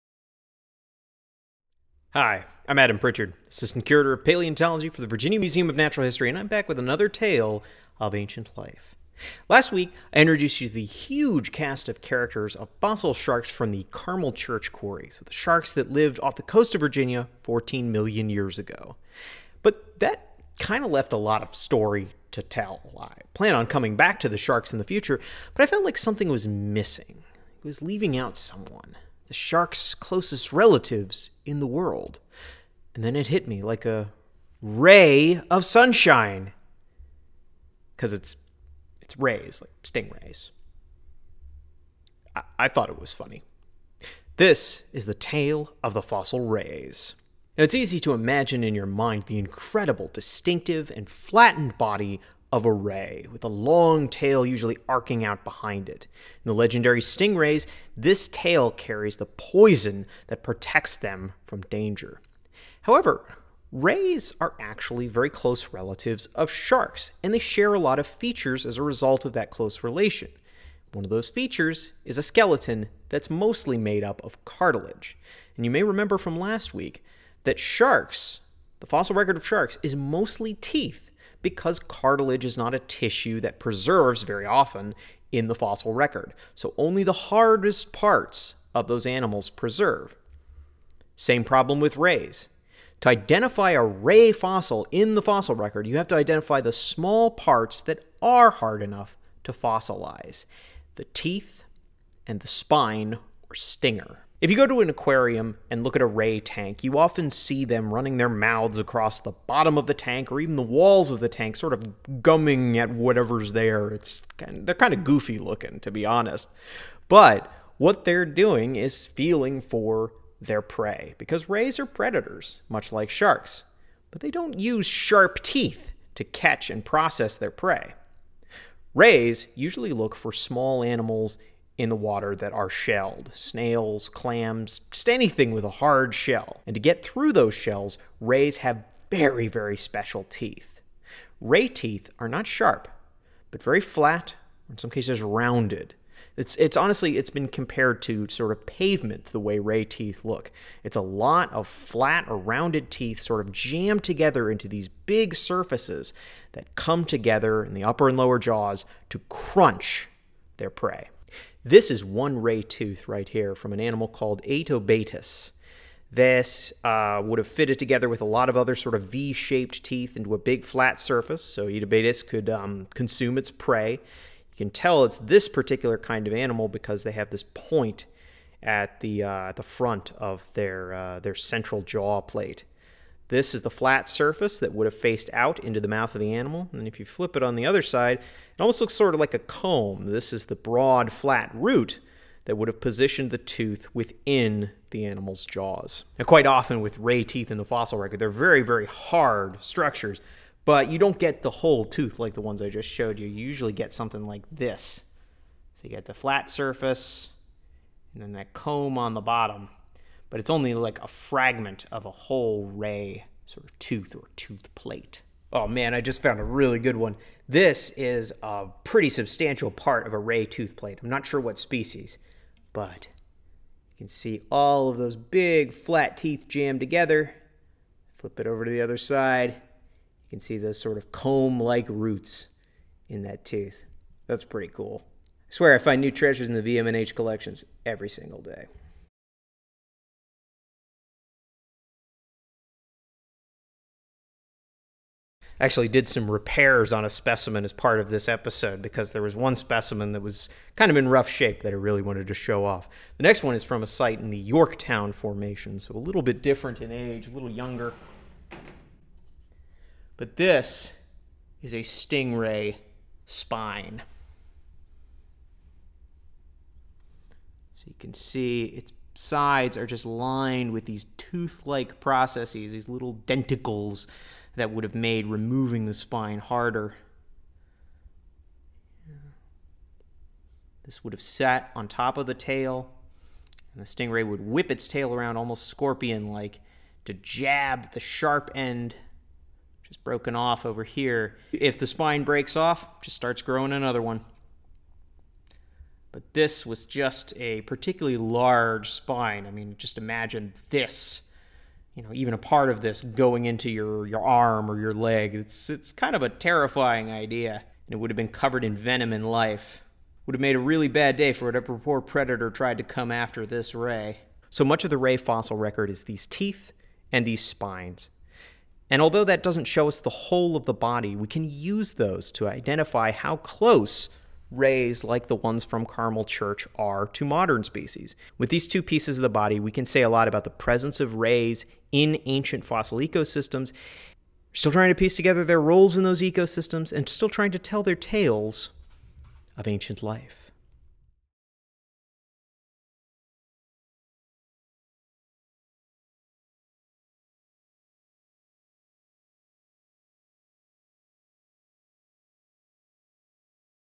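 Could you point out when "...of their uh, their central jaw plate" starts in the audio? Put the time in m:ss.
3:00.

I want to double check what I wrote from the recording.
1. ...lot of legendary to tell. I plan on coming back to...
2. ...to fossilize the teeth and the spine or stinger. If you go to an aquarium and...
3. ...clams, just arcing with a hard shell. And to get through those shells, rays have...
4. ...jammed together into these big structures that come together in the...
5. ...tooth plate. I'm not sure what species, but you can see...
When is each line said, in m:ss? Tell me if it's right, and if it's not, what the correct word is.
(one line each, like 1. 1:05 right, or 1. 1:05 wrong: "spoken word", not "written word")
1. 0:21 wrong: "story", not "legendary"
2. 1:39 right
3. 2:14 wrong: "anything", not "arcing"
4. 2:33 wrong: "surfaces", not "structures"
5. 3:40 right.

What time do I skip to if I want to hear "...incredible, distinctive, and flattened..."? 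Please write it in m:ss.
0:49.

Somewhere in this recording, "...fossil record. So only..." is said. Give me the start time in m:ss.
1:25.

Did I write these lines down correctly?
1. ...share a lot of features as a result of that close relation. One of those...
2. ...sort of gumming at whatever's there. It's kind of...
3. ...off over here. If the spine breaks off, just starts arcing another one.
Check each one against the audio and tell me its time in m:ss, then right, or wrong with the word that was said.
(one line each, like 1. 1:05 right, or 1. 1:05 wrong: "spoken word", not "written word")
1. 1:07 right
2. 1:51 right
3. 4:50 wrong: "growing", not "arcing".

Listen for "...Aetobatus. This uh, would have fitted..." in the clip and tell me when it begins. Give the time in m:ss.
2:44.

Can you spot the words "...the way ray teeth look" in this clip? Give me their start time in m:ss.
2:29.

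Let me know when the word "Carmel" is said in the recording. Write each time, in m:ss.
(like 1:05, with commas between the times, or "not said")
0:13, 5:25.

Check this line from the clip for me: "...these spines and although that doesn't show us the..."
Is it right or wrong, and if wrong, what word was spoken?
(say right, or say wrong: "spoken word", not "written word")
right.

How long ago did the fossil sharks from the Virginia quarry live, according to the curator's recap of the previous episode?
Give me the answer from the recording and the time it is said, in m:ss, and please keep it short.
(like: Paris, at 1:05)
14 million years ago, at 0:17.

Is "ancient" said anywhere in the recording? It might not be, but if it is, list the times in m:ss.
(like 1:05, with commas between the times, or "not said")
0:08, 5:32, 5:39.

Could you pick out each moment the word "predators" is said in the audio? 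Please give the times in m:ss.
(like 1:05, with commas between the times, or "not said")
2:01, 5:11.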